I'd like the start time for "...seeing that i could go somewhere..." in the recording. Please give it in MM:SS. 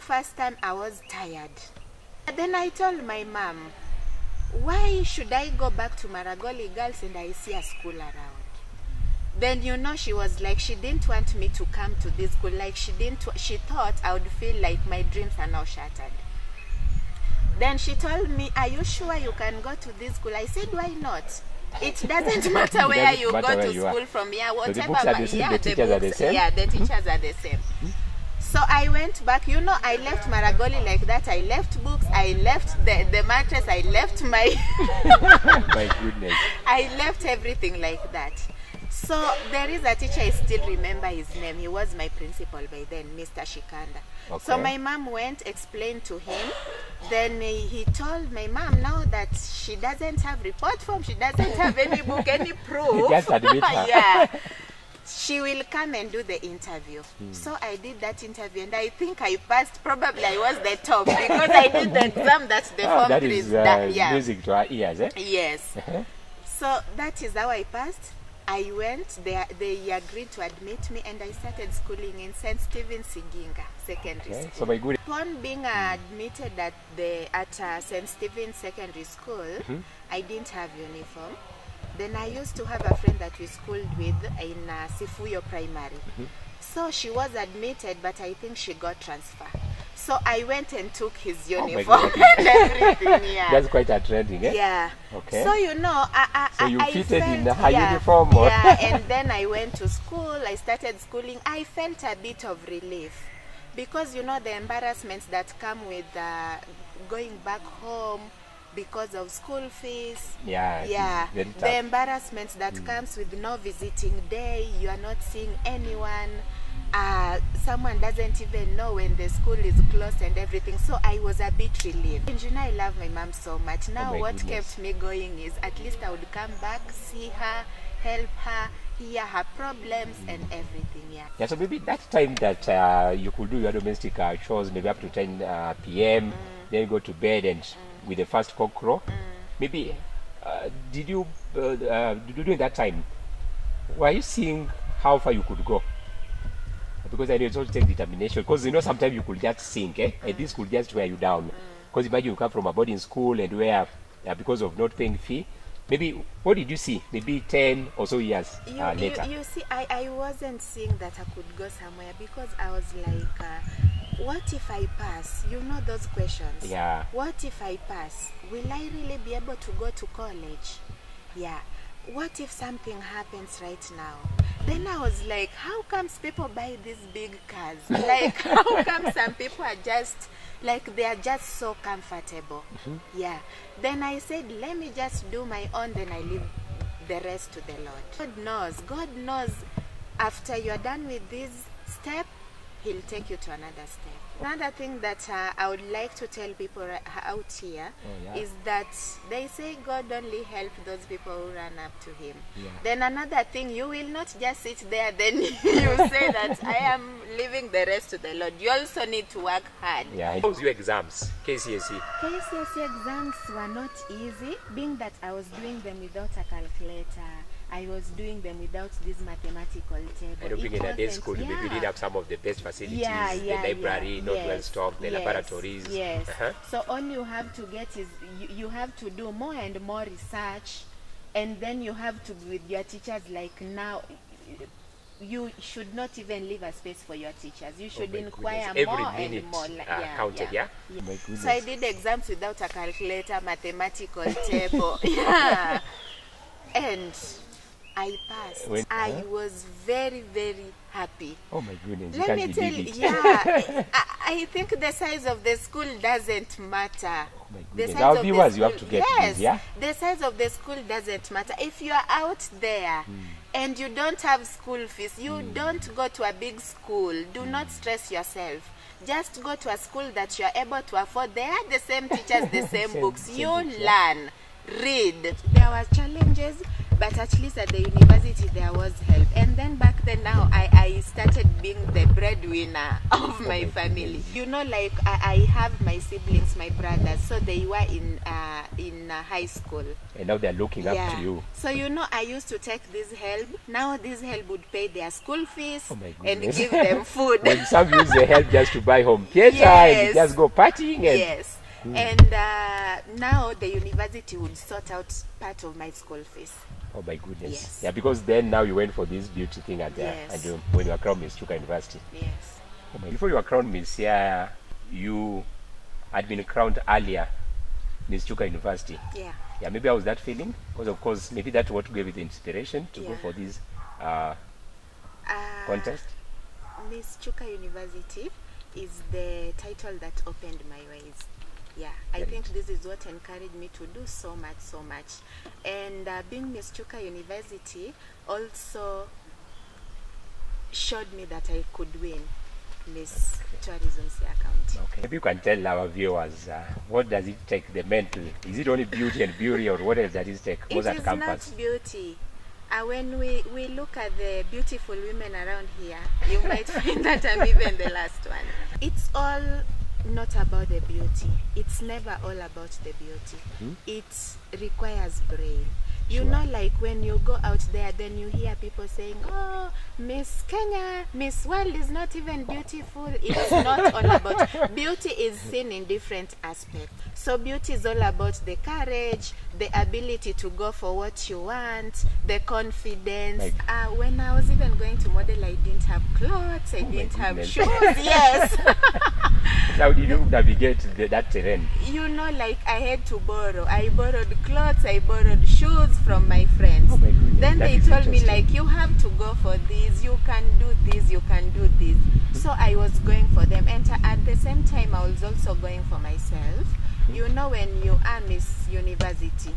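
02:40.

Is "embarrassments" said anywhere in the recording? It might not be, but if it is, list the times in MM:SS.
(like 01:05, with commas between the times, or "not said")
01:44, 01:51.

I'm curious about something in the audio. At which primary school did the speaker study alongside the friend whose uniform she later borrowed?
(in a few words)
Sifuyo Primary.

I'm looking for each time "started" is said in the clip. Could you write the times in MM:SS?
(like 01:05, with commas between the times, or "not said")
01:11, 01:40, 04:40.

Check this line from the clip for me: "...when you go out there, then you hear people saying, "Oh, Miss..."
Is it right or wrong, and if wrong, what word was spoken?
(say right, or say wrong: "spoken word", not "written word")
right.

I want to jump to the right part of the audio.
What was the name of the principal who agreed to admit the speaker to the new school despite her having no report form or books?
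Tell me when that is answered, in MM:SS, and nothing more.
00:43.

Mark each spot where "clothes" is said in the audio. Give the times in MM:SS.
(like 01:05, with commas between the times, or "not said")
06:26, 06:34.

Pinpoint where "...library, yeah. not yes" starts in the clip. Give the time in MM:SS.
03:43.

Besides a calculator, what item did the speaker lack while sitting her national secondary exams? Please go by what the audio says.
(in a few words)
Mathematical table.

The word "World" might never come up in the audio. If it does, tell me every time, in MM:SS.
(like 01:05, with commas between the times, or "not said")
06:11.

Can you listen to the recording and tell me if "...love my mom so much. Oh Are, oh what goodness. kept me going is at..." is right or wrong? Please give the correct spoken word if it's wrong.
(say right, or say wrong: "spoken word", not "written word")
wrong: "Now", not "Are".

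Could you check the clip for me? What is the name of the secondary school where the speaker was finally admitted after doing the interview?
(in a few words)
St. Stephen Siginga Secondary.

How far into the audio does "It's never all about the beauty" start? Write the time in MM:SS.
06:01.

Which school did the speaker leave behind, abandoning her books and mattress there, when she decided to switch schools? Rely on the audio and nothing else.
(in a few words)
Maragoli Girls.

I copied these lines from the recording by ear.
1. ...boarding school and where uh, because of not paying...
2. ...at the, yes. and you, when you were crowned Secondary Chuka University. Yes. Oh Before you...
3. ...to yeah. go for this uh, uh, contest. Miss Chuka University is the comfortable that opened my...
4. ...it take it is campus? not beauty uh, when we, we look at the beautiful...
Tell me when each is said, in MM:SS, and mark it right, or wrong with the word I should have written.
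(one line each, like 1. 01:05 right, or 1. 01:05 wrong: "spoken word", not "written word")
1. 02:32 right
2. 05:09 wrong: "Miss", not "Secondary"
3. 05:22 wrong: "title", not "comfortable"
4. 05:50 right.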